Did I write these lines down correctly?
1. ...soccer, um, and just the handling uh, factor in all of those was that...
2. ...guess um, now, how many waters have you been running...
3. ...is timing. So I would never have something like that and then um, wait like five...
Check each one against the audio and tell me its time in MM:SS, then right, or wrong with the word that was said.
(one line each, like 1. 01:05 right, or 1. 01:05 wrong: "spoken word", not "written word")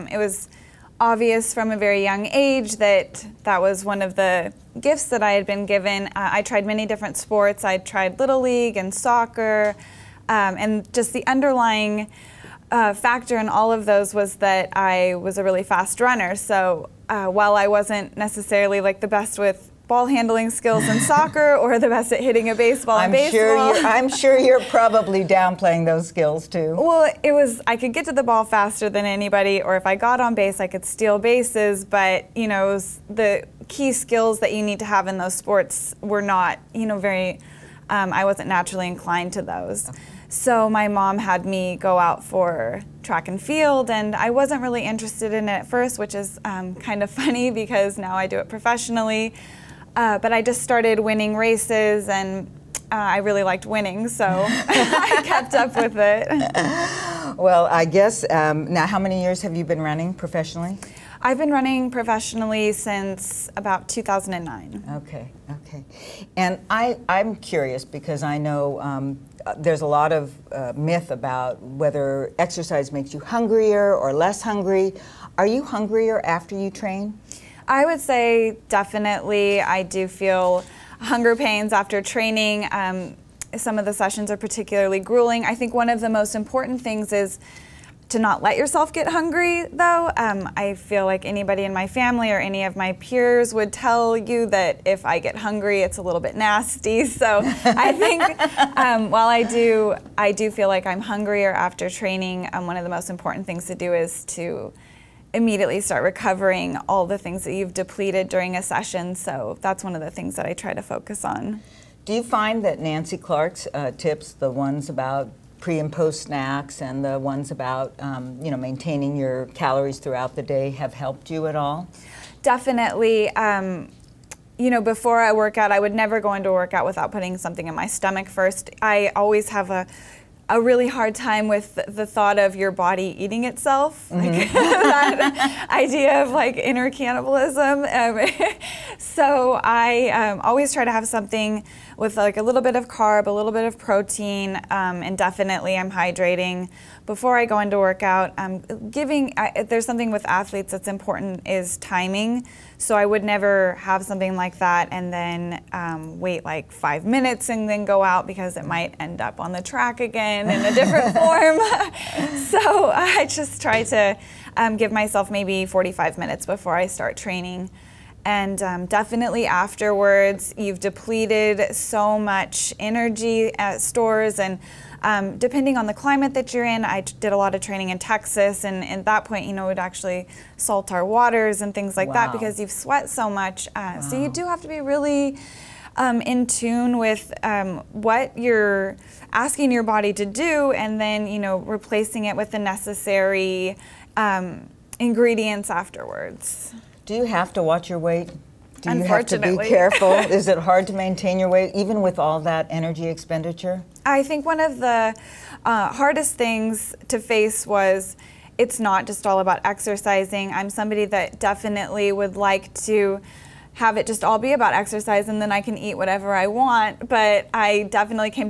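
1. 00:08 wrong: "underlying", not "handling"
2. 00:57 wrong: "years", not "waters"
3. 02:31 right.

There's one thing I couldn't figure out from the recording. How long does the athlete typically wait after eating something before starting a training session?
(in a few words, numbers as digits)
45 minutes.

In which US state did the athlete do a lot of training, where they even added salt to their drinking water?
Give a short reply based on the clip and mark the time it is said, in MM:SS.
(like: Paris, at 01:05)
Texas, at 02:57.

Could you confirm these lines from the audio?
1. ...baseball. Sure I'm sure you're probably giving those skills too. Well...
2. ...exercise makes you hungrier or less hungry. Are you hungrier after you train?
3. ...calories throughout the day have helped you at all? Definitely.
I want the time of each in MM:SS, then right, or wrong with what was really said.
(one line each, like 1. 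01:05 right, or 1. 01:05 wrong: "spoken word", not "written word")
1. 00:23 wrong: "downplaying", not "giving"
2. 01:12 right
3. 01:59 right.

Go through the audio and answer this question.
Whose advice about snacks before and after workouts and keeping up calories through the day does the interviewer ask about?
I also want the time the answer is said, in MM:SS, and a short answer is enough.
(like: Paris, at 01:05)
Nancy Clark, at 01:52.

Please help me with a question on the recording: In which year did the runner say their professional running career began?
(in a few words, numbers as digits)
2009.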